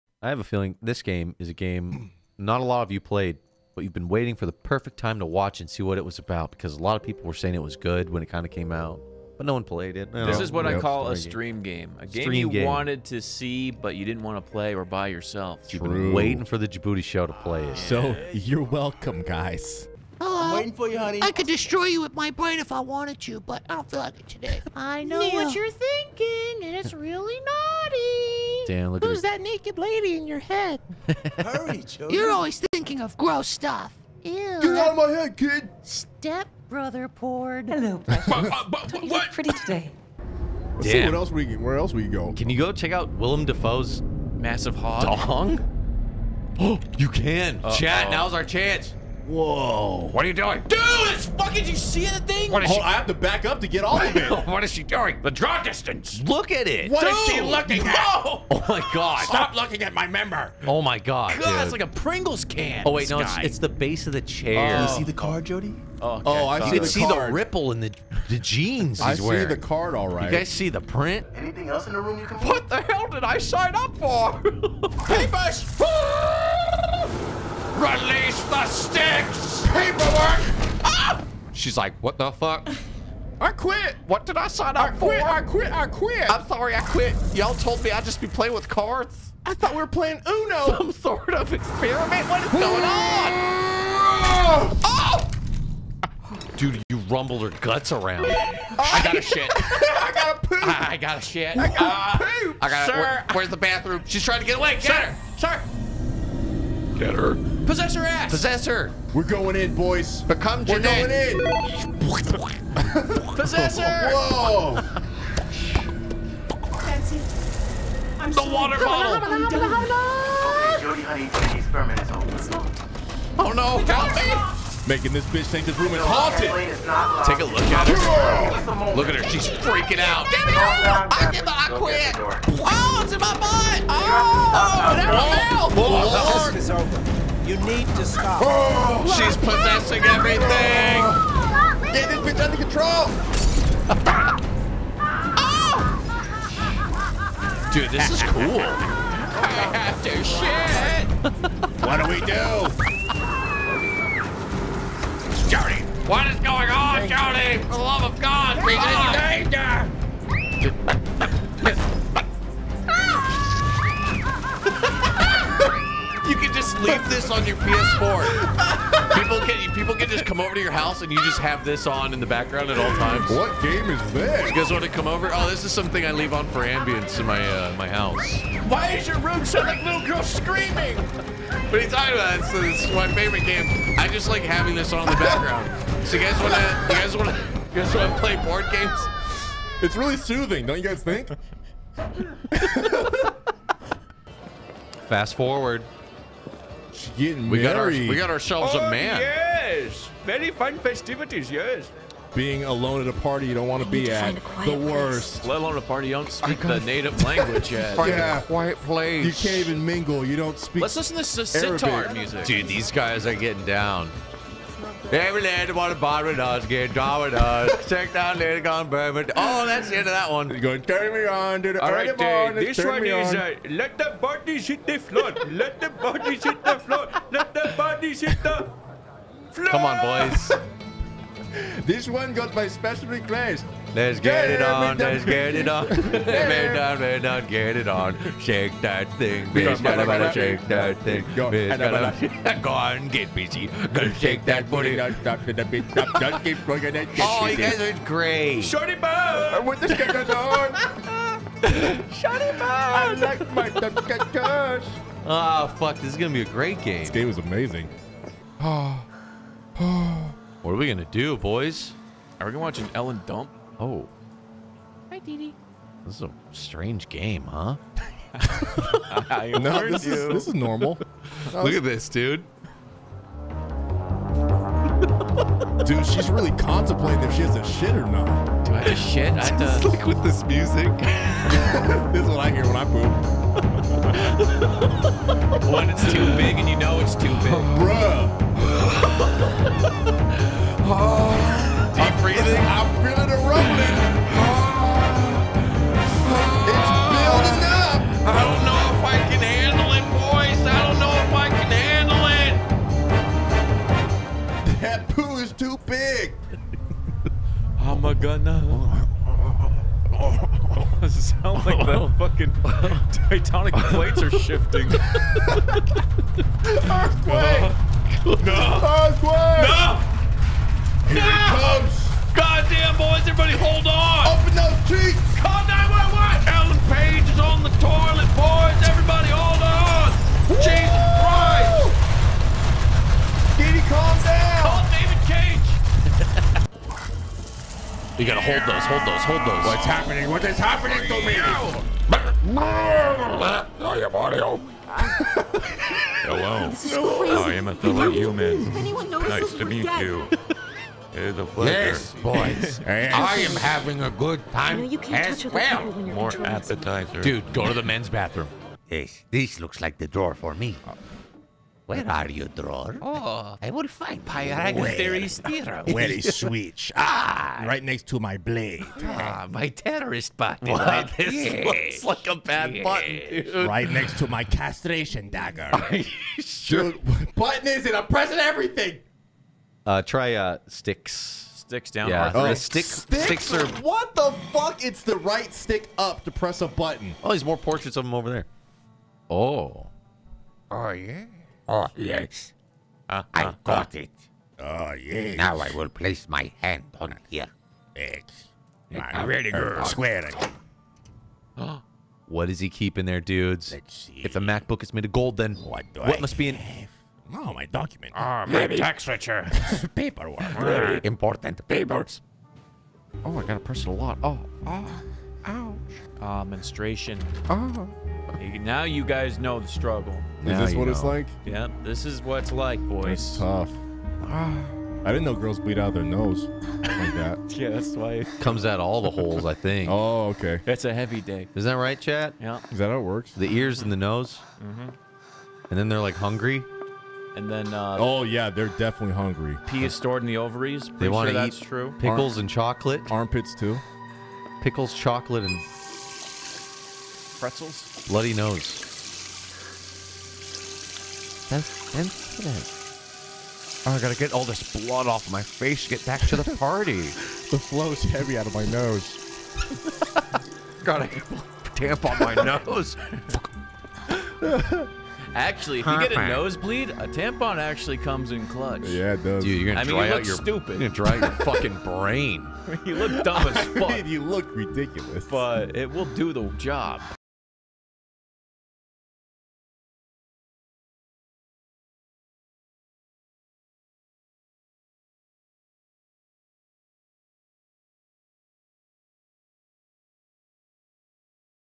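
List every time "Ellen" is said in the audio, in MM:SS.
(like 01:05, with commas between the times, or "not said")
04:22, 05:26.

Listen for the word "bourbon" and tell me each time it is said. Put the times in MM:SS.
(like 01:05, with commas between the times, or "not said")
03:38.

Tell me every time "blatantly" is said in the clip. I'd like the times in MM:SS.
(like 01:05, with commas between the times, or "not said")
not said.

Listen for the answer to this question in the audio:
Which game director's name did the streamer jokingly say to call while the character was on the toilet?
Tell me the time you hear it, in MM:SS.
05:34.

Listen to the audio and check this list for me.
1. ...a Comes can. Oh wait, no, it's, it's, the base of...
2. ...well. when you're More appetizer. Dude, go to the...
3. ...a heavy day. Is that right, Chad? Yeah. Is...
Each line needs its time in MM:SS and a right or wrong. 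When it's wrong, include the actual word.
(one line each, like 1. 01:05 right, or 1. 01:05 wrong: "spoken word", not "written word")
1. 01:01 wrong: "Pringles", not "Comes"
2. 05:55 right
3. 07:10 right.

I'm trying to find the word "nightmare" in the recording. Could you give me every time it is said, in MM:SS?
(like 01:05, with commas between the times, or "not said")
not said.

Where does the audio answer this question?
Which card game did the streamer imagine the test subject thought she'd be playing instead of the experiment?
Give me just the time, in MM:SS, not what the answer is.
01:30.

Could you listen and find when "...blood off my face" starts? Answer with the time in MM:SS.
07:34.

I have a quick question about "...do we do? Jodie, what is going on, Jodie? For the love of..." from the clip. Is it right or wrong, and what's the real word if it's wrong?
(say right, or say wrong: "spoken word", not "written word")
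right.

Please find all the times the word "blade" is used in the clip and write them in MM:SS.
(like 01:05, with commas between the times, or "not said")
06:08.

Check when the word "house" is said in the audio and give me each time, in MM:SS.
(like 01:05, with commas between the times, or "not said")
02:50, 02:57.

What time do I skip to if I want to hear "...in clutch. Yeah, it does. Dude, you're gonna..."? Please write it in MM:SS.
07:48.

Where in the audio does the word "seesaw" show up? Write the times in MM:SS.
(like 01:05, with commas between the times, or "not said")
not said.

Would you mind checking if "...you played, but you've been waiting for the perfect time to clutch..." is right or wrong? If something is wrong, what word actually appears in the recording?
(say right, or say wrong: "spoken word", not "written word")
wrong: "watch", not "clutch".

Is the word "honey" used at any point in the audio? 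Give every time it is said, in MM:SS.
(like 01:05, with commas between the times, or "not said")
00:20, 02:01.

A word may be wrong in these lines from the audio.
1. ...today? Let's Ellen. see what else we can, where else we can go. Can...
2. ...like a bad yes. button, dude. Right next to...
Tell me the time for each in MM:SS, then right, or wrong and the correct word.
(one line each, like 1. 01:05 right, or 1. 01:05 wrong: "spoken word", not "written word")
1. 00:39 wrong: "Damn", not "Ellen"
2. 06:12 right.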